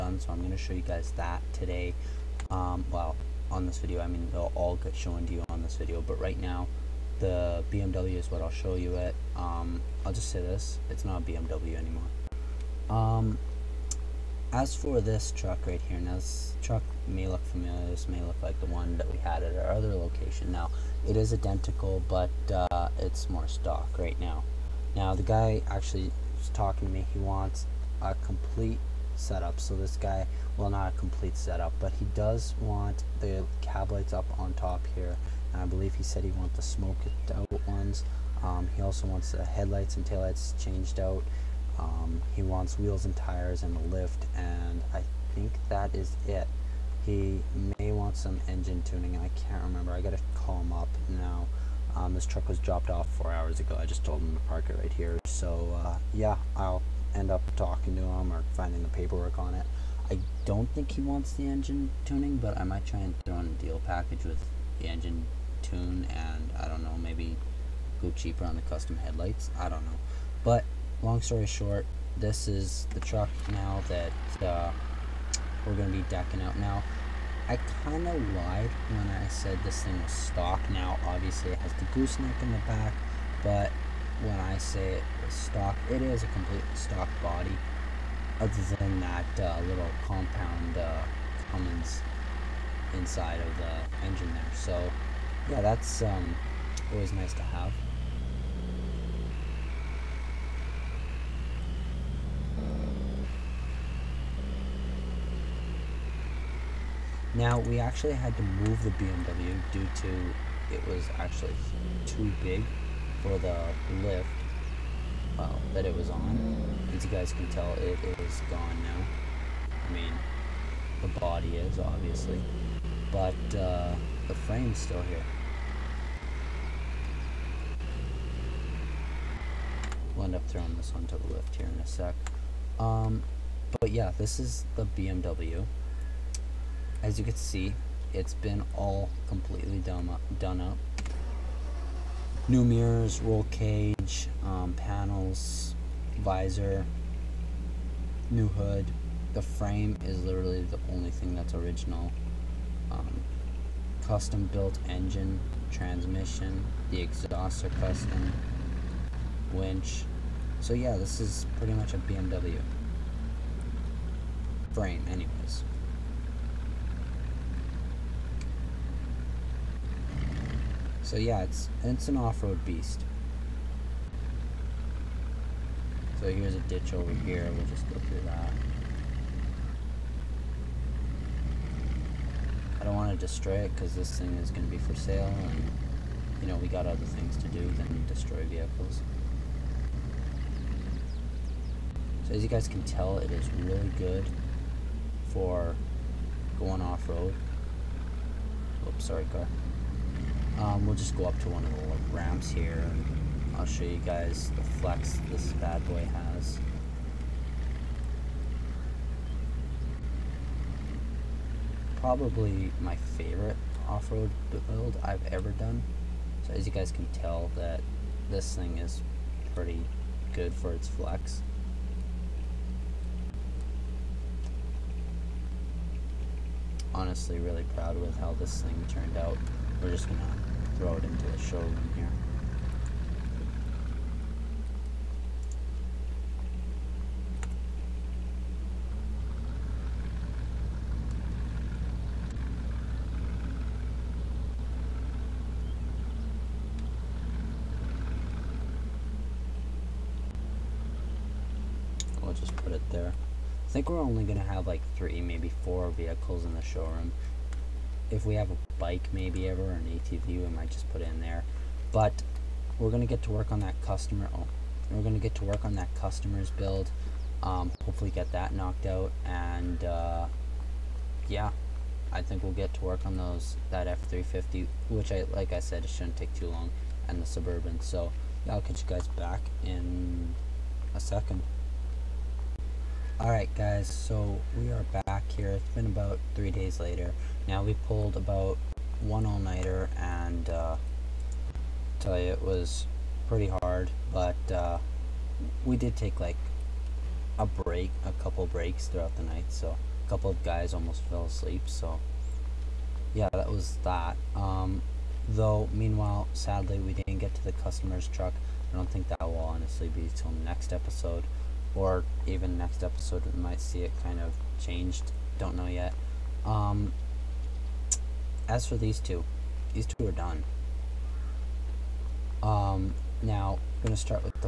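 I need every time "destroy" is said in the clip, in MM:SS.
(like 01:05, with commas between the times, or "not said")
03:03, 03:08.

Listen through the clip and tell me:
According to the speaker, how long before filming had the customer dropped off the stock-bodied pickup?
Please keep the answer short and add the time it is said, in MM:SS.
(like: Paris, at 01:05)
4 hours, at 00:53.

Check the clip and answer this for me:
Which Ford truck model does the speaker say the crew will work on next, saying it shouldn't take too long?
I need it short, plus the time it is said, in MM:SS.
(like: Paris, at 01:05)
F-350, at 04:33.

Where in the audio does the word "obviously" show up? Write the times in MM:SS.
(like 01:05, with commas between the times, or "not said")
01:21, 02:01.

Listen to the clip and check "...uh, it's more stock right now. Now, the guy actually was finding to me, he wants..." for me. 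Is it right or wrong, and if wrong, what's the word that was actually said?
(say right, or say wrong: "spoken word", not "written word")
wrong: "talking", not "finding".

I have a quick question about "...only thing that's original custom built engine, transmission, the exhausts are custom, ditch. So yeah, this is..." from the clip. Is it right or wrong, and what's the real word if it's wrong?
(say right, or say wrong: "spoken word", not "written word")
wrong: "winch", not "ditch".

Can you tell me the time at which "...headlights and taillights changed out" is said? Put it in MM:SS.
00:39.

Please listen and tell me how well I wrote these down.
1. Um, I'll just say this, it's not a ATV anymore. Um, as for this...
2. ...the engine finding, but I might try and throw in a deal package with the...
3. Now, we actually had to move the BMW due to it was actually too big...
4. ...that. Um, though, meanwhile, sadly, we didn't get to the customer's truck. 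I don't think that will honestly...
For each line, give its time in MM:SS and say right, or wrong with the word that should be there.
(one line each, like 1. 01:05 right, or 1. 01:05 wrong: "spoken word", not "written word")
1. 00:09 wrong: "BMW", not "ATV"
2. 01:01 wrong: "tuning", not "finding"
3. 01:47 right
4. 05:03 right.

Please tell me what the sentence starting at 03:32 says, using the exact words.
probably my favorite off-road build I've ever done.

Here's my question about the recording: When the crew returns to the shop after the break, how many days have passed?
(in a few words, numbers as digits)
3 days.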